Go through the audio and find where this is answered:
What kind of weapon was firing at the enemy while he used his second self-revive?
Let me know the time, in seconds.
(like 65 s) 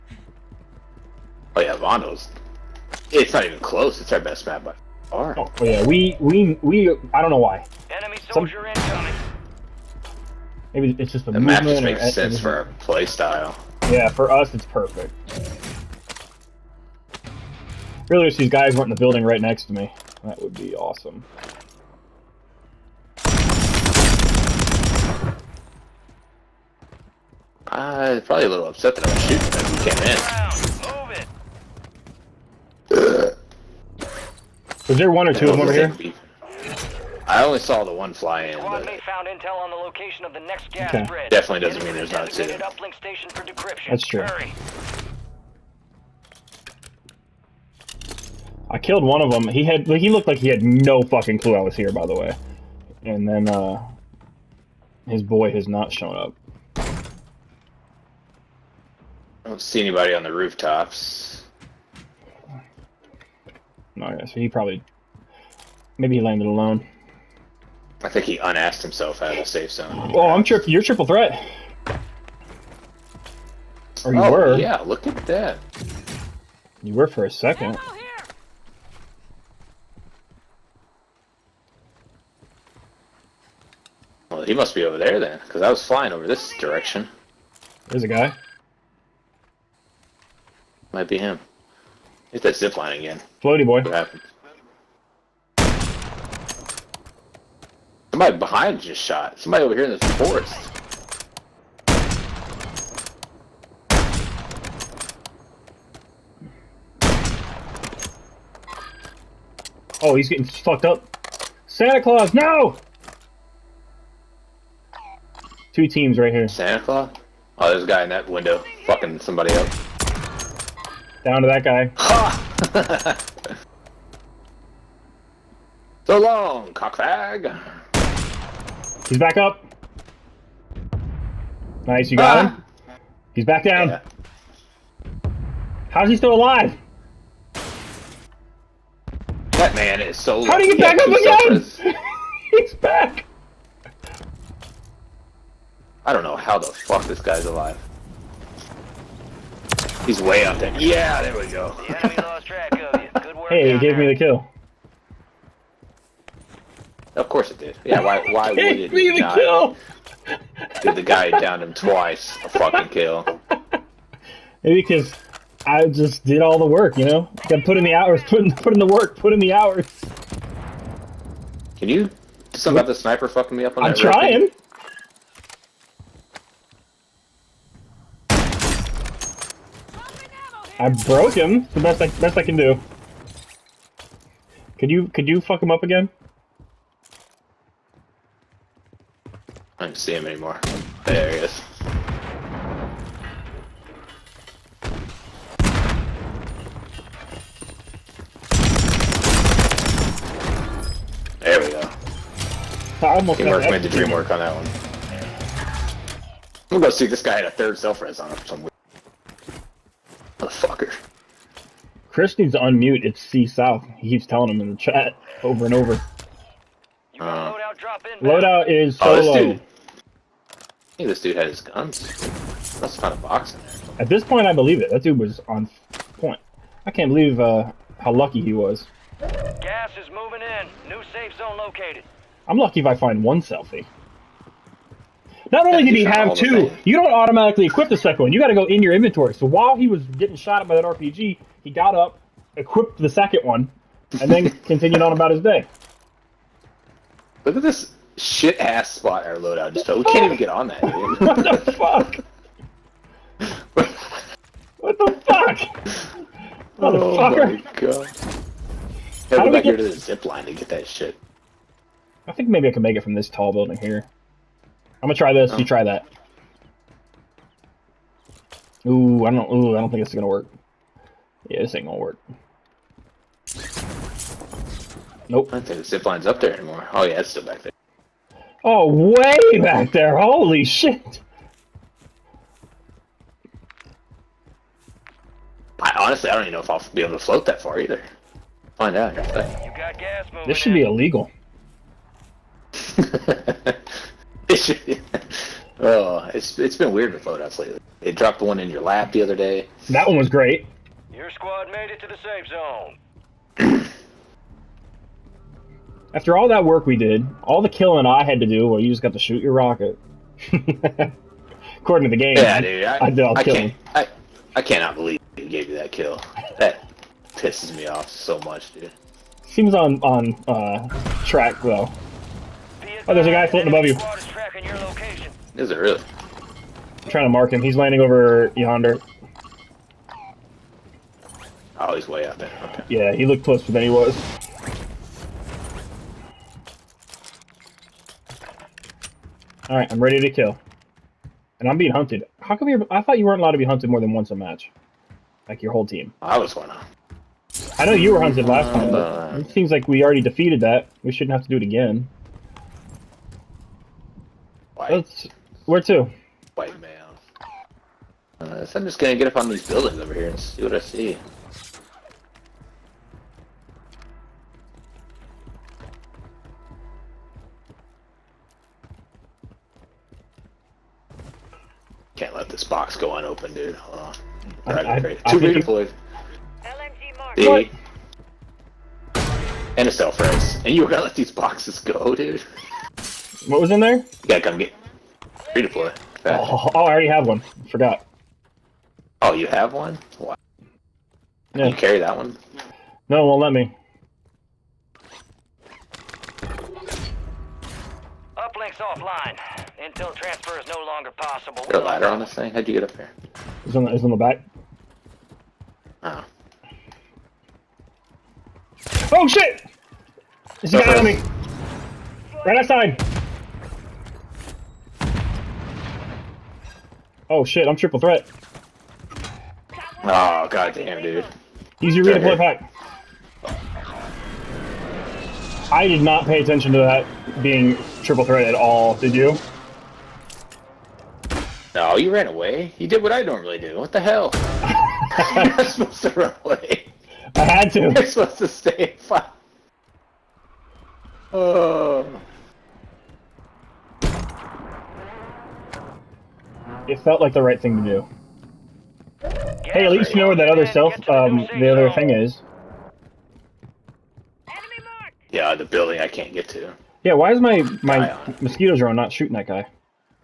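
240 s.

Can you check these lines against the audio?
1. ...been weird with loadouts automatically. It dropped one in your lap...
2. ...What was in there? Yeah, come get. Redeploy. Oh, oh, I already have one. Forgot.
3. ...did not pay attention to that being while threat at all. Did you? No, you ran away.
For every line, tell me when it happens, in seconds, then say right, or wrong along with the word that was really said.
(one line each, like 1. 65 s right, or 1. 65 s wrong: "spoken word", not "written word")
1. 296 s wrong: "lately", not "automatically"
2. 383 s right
3. 425 s wrong: "triple", not "while".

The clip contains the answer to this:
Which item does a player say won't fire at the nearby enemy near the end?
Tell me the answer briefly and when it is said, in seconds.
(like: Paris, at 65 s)
Mosquito drone, at 458 s.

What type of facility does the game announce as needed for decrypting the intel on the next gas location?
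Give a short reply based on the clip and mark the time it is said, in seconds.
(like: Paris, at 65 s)
Uplink station, at 42 s.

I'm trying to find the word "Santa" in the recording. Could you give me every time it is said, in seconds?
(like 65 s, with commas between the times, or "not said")
111 s, 116 s.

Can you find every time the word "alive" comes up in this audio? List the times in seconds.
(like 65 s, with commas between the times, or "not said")
136 s, 147 s.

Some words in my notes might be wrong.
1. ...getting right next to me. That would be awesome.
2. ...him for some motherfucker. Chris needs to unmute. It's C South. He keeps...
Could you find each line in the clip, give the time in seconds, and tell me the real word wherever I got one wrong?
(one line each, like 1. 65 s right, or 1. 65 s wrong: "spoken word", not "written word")
1. 18 s wrong: "building", not "getting"
2. 208 s right.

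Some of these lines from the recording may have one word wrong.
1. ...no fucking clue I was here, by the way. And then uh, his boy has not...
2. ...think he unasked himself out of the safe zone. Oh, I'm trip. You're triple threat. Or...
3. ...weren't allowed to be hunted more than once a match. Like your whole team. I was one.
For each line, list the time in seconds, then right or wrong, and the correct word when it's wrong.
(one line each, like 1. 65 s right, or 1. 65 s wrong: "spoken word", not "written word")
1. 50 s right
2. 68 s right
3. 343 s right.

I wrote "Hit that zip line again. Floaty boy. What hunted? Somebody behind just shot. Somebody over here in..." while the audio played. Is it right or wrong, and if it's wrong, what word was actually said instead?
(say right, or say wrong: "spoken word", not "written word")
wrong: "happened", not "hunted".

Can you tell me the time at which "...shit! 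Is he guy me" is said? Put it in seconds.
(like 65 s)
409 s.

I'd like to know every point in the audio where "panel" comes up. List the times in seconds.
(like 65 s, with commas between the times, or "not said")
not said.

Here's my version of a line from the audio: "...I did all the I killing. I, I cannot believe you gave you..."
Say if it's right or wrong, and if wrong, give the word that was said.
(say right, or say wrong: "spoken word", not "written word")
right.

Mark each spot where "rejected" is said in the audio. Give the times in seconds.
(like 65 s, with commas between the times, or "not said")
not said.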